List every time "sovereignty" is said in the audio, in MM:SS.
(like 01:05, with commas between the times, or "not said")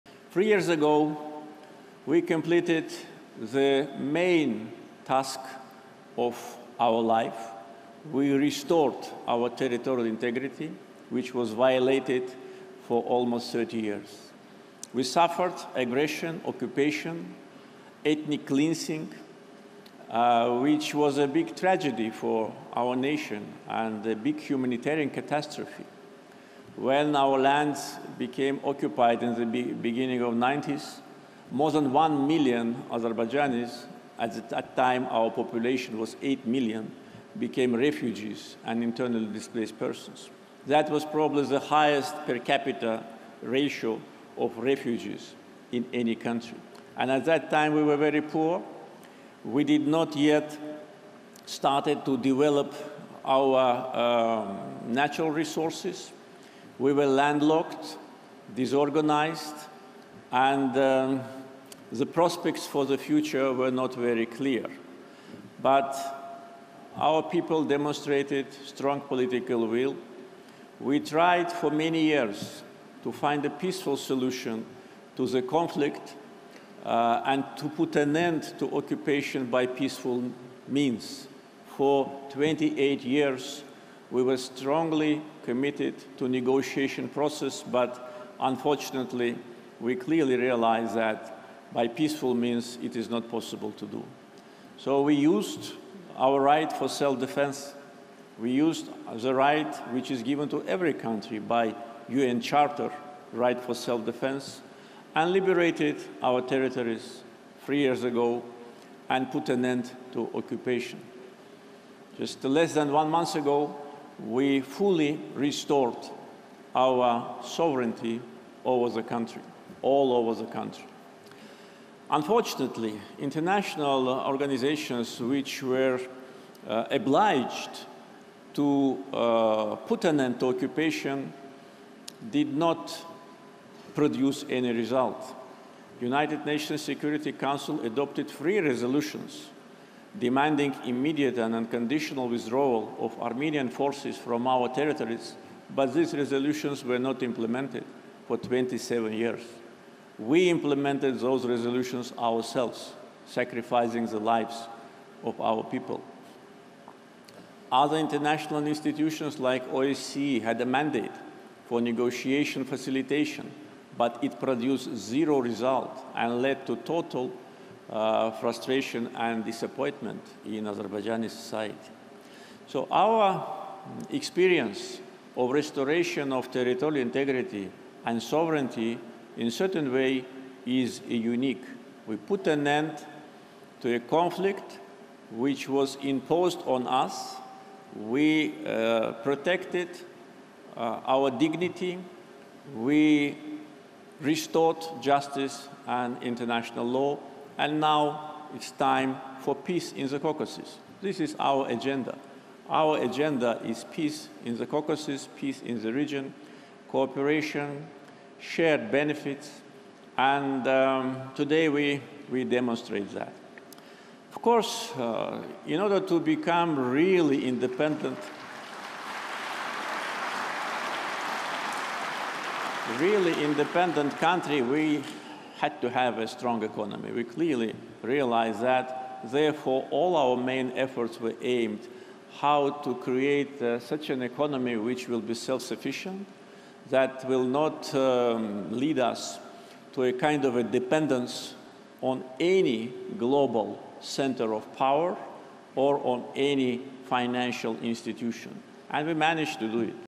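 01:57, 02:58.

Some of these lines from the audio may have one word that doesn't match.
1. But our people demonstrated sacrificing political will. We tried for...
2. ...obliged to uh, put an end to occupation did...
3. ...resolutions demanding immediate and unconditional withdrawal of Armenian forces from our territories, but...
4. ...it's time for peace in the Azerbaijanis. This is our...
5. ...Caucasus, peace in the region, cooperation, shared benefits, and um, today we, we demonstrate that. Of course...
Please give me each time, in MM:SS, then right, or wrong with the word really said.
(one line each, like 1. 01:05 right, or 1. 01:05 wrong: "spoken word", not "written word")
1. 01:05 wrong: "strong", not "sacrificing"
2. 02:06 right
3. 02:18 right
4. 03:18 wrong: "Caucasus", not "Azerbaijanis"
5. 03:24 right.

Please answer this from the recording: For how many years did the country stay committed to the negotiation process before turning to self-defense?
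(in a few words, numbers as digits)
28.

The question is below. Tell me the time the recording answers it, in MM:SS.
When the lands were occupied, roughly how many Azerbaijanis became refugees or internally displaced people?
00:31.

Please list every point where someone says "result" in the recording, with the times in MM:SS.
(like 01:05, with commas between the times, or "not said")
02:14, 02:45.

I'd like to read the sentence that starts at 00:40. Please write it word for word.
That was probably the highest per capita ratio of refugees in any country.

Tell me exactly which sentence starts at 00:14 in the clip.
We suffered aggression, occupation, ethnic cleansing, uh, which was a big tragedy for our nation and a big humanitarian catastrophe.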